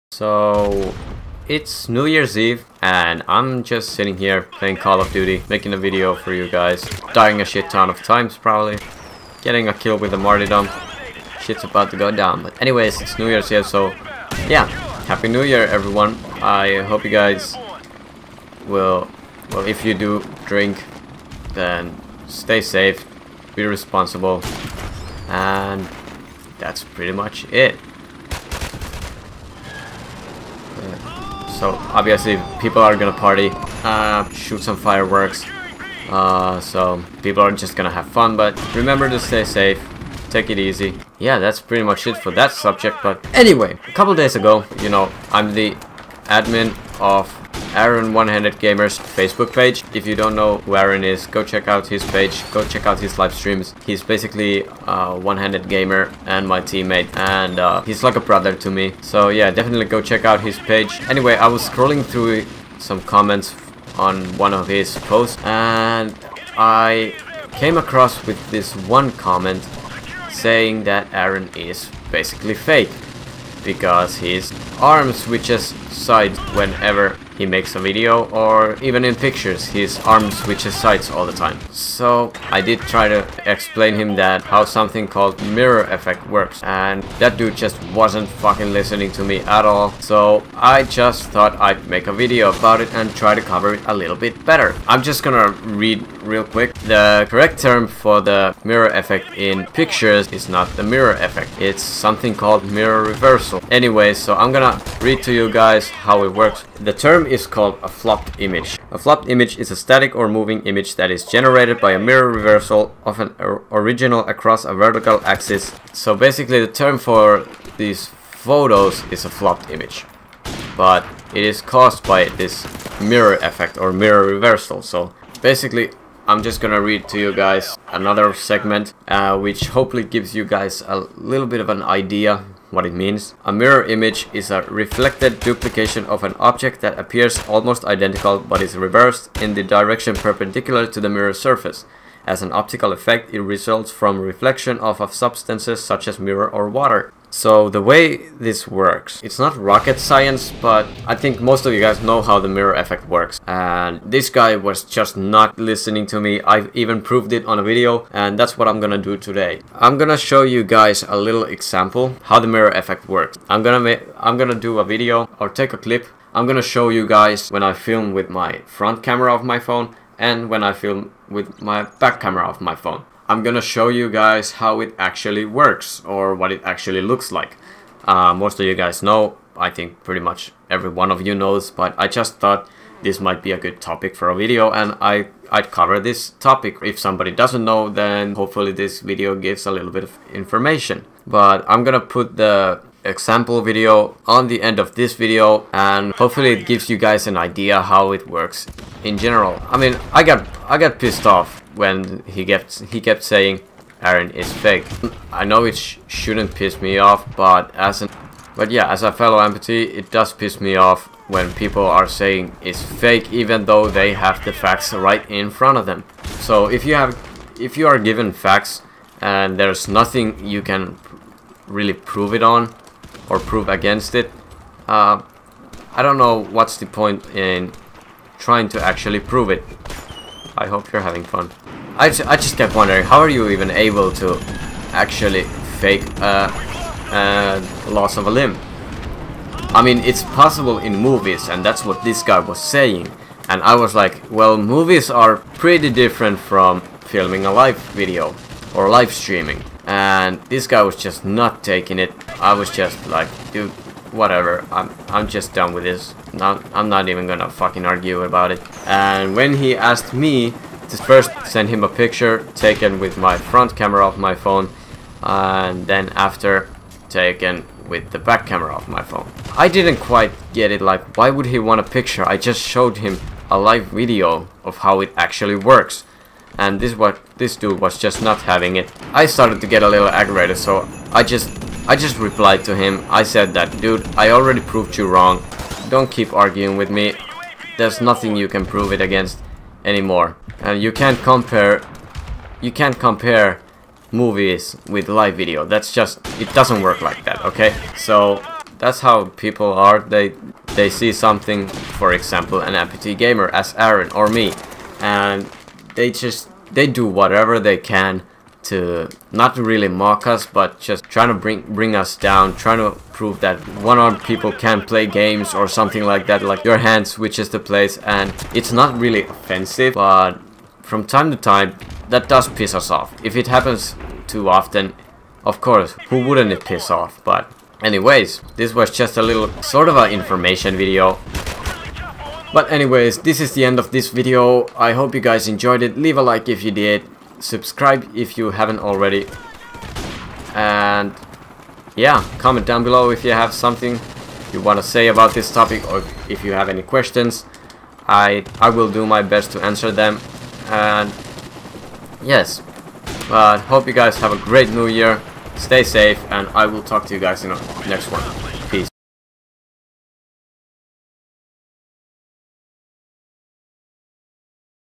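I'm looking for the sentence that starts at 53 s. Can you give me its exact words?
He's basically a uh, one handed gamer and my teammate, and uh, he's like a brother to me.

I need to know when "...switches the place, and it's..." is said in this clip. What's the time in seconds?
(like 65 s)
317 s.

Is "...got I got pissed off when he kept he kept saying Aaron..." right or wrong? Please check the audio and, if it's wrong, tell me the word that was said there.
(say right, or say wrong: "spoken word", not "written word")
right.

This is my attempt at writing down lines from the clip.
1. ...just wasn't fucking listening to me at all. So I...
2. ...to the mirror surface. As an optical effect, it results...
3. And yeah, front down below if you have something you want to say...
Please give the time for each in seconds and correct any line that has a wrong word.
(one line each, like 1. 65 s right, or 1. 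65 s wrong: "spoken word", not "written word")
1. 87 s right
2. 140 s right
3. 340 s wrong: "comment", not "front".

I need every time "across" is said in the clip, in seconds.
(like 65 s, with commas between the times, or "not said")
67 s, 114 s.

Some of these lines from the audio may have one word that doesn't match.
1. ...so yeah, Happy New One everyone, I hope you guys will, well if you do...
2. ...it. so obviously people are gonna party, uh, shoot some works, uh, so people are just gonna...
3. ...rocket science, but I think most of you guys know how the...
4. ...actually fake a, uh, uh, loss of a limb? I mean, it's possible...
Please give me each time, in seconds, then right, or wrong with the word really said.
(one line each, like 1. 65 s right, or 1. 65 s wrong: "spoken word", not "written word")
1. 13 s wrong: "Year", not "One"
2. 27 s wrong: "fireworks", not "works"
3. 149 s right
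4. 234 s right.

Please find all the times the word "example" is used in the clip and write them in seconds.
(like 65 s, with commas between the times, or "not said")
161 s, 193 s, 302 s.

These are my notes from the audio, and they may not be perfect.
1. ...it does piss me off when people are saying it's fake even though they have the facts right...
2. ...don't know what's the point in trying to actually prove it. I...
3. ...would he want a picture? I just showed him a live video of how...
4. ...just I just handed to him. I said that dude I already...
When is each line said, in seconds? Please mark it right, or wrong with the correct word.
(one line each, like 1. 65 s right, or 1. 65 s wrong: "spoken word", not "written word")
1. 209 s right
2. 226 s right
3. 271 s right
4. 281 s wrong: "replied", not "handed".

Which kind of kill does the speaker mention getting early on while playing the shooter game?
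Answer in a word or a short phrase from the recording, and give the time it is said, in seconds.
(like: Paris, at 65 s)
martyrdom, at 10 s.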